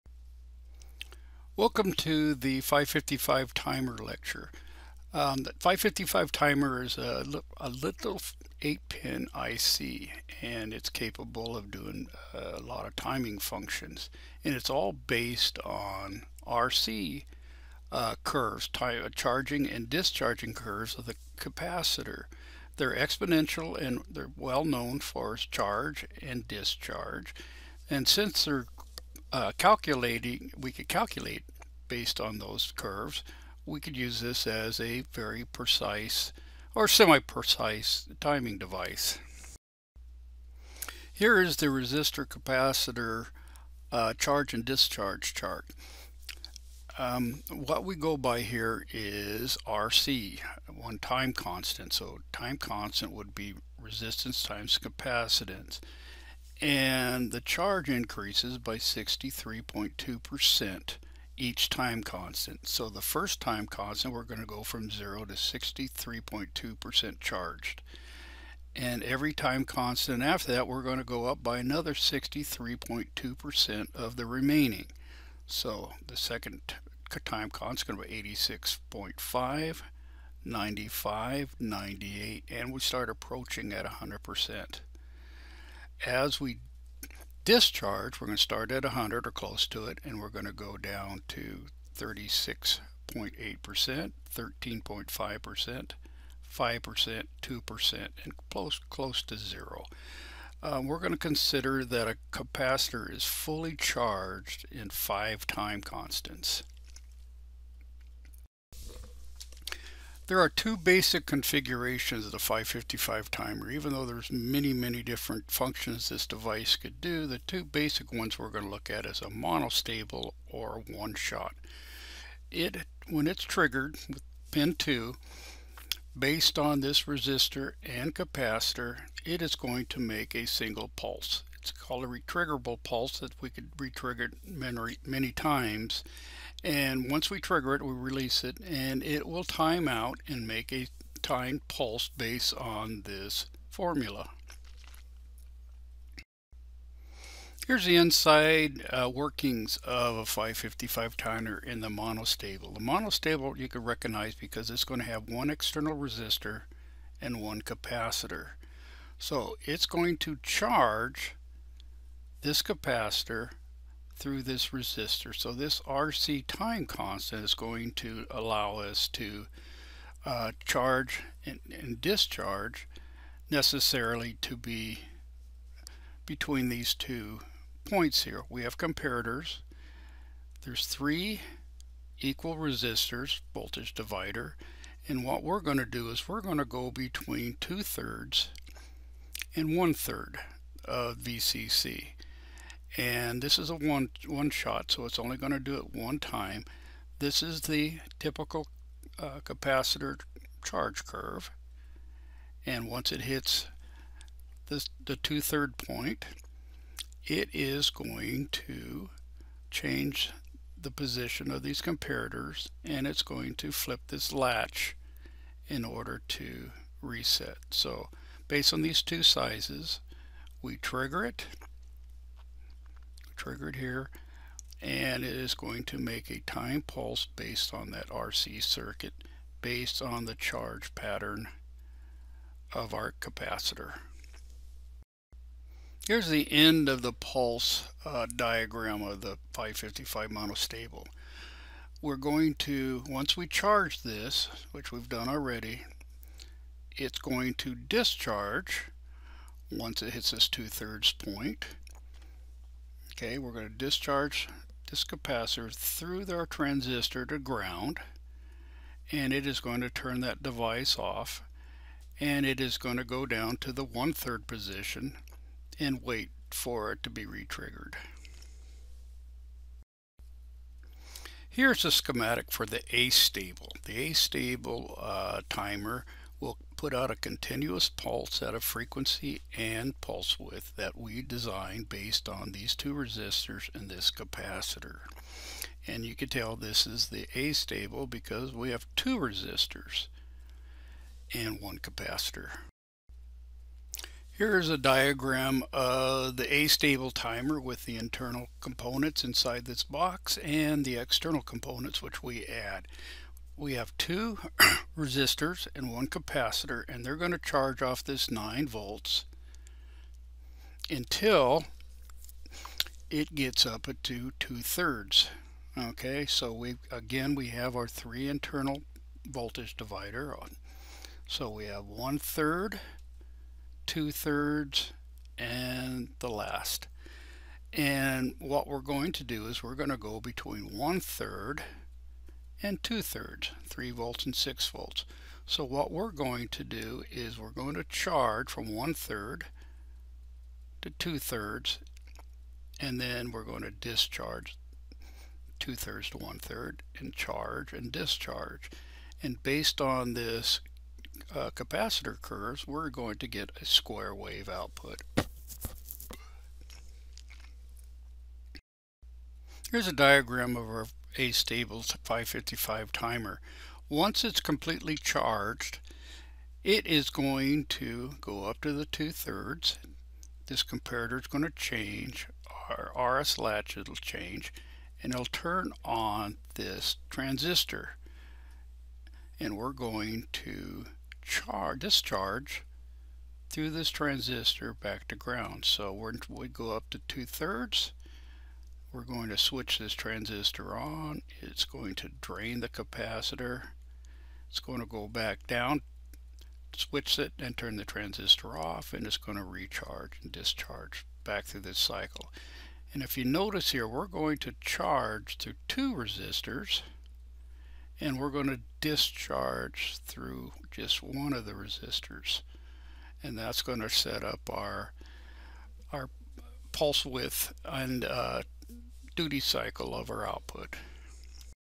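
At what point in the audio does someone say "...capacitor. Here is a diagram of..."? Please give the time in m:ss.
4:51.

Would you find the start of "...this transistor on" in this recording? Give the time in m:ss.
6:29.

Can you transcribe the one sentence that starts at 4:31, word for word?
Here's a schematic for the astable.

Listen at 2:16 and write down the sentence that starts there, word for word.
And once we trigger it, we release it, and it will time out and make a timed pulse based on this formula.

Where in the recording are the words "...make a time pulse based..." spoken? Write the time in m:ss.
3:45.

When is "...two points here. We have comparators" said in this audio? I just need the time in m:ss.
2:56.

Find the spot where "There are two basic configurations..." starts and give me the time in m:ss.
1:50.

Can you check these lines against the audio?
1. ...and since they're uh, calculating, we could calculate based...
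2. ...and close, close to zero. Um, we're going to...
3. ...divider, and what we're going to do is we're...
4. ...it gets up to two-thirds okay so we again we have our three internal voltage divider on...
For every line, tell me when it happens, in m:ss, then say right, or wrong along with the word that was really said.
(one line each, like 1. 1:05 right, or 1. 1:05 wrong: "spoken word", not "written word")
1. 0:27 right
2. 1:38 right
3. 3:03 right
4. 5:13 right.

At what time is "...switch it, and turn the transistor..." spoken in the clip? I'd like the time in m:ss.
6:36.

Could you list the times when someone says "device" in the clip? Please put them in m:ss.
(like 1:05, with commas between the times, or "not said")
0:38, 1:56, 4:20.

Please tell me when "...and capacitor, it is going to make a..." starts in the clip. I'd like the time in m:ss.
2:07.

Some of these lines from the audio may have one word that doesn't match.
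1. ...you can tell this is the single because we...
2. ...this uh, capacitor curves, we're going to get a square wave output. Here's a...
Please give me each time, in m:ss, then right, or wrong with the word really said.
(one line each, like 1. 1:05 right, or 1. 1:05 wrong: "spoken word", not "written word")
1. 4:46 wrong: "astable", not "single"
2. 5:50 right.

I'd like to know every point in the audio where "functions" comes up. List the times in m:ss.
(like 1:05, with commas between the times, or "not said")
0:13, 1:55.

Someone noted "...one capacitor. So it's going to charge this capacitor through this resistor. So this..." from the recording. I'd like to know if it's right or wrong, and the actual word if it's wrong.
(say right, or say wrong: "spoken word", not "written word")
right.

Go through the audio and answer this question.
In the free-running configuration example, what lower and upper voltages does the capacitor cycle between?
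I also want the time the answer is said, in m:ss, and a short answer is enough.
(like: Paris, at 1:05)
3 and 6 volts, at 5:33.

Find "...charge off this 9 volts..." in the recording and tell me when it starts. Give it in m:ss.
5:07.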